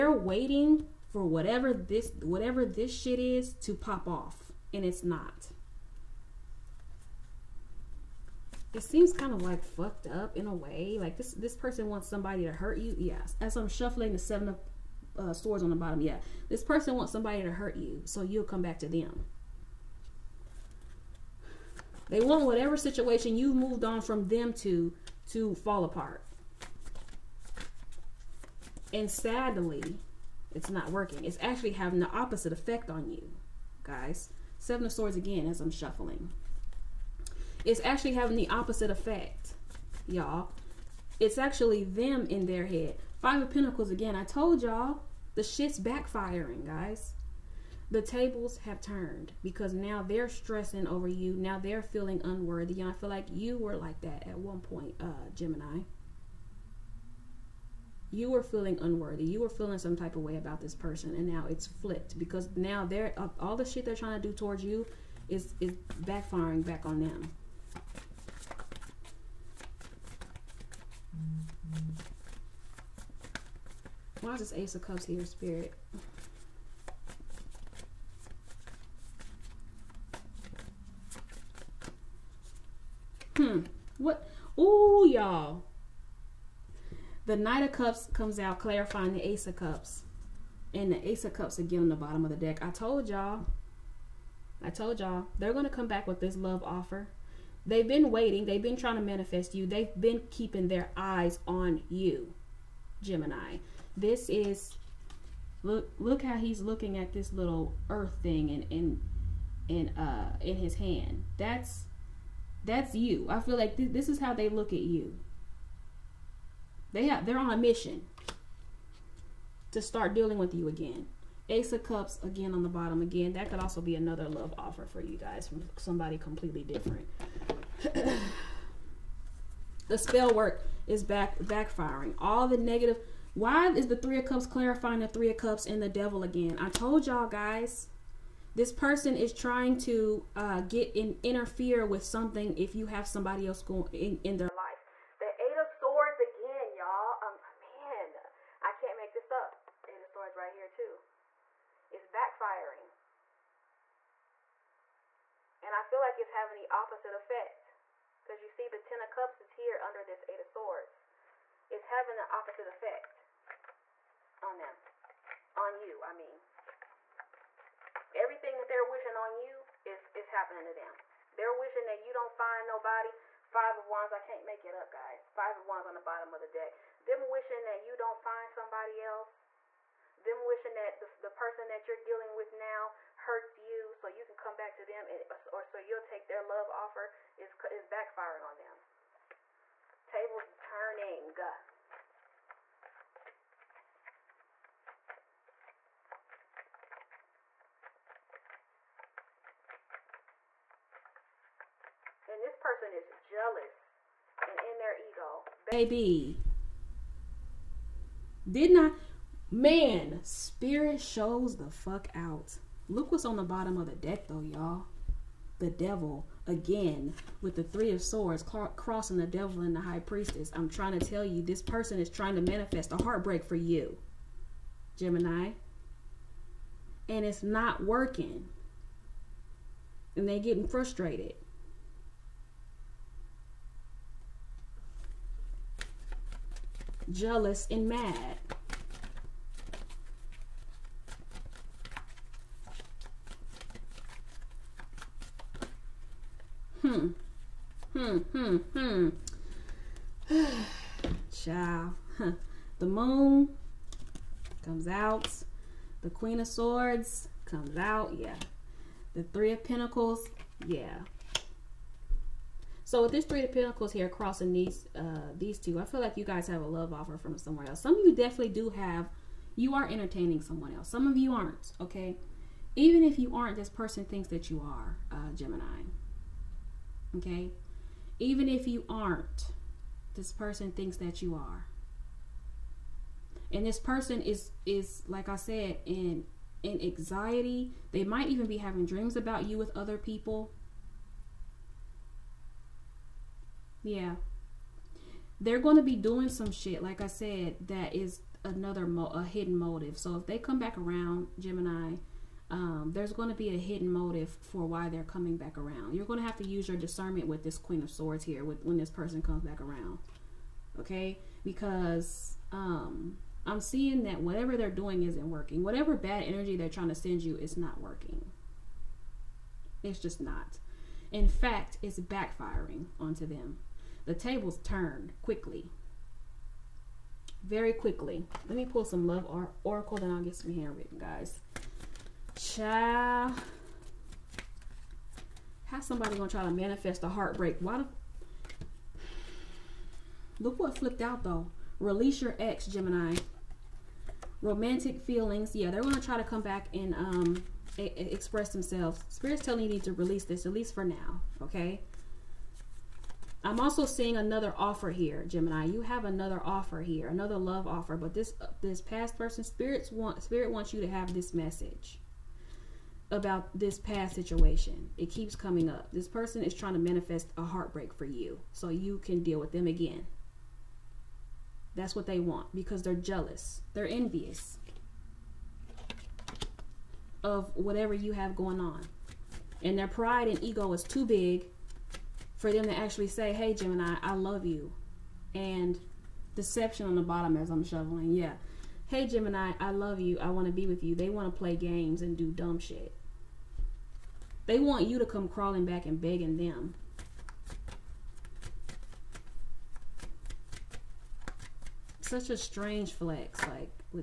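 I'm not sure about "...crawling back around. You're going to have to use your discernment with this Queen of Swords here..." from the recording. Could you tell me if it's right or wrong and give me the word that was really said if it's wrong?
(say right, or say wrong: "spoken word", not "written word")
wrong: "coming", not "crawling".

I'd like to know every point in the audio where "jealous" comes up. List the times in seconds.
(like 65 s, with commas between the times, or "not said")
203 s, 237 s, 372 s.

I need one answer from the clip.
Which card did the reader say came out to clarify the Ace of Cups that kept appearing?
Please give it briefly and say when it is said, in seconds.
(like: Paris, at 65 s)
Knight of Cups, at 87 s.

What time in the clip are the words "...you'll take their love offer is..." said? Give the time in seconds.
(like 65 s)
185 s.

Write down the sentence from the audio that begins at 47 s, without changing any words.
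The tables have turned because now they're stressing over you.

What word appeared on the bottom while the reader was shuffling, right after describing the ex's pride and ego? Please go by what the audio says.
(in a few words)
Deception.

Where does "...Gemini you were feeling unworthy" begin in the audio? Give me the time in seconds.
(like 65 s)
55 s.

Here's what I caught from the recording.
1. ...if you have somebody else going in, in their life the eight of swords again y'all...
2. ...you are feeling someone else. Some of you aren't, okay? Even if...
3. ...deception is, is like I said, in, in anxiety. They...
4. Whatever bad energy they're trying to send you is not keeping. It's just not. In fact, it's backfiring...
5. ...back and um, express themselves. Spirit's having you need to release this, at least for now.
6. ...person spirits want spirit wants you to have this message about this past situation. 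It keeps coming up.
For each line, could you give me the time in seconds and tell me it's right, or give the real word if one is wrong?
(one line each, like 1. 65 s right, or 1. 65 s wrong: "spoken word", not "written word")
1. 142 s right
2. 269 s wrong: "entertaining", not "feeling"
3. 283 s wrong: "person", not "deception"
4. 315 s wrong: "working", not "keeping"
5. 346 s wrong: "telling", not "having"
6. 359 s right.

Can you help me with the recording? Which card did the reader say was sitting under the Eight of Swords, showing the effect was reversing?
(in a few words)
Ten of Cups.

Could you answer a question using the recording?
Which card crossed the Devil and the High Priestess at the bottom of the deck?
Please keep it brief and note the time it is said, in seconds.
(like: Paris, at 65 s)
Three of Swords, at 217 s.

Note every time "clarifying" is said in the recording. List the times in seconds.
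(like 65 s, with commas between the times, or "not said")
88 s, 134 s.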